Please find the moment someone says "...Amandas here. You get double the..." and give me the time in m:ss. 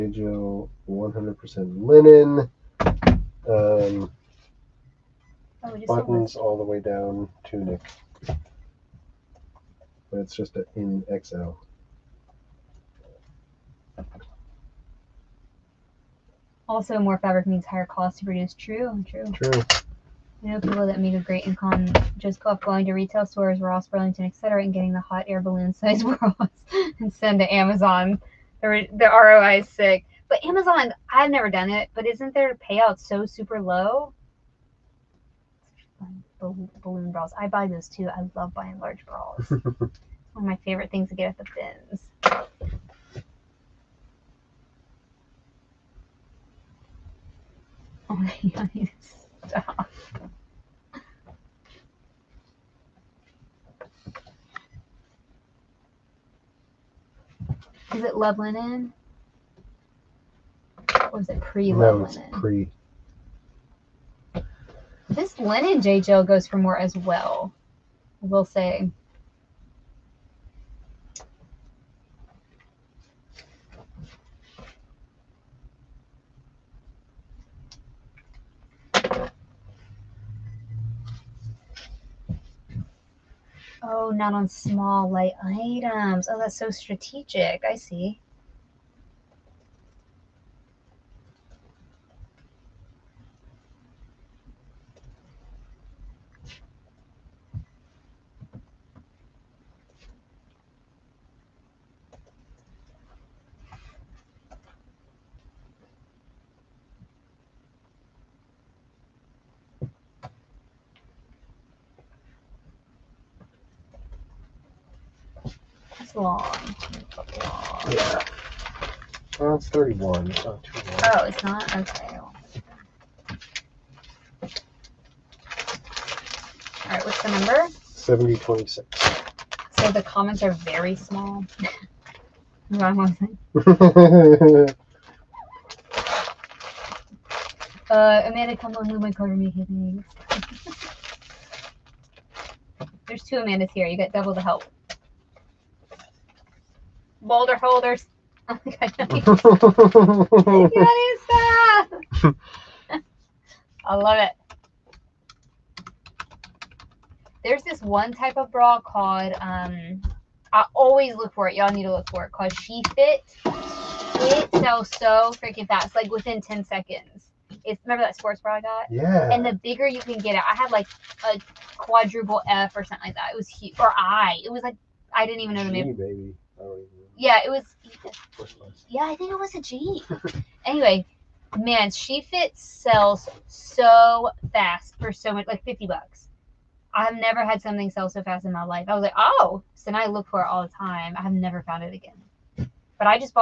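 2:23.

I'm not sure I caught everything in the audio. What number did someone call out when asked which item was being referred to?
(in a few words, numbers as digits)
7026.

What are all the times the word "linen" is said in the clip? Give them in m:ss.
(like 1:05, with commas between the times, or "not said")
0:01, 0:58, 1:05.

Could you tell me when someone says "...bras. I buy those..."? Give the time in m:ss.
0:37.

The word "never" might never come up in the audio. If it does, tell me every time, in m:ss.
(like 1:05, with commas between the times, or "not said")
0:31, 3:07, 3:11.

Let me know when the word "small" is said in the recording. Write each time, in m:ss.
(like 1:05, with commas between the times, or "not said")
1:24, 2:10.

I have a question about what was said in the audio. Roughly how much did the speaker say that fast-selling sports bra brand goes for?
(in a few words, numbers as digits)
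$50.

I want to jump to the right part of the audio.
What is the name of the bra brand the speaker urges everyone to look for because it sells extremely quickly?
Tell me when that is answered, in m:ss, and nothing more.
2:42.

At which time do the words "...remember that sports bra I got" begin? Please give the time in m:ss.
2:47.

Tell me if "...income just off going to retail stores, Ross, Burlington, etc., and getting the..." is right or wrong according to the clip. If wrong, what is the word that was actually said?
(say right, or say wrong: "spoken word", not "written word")
right.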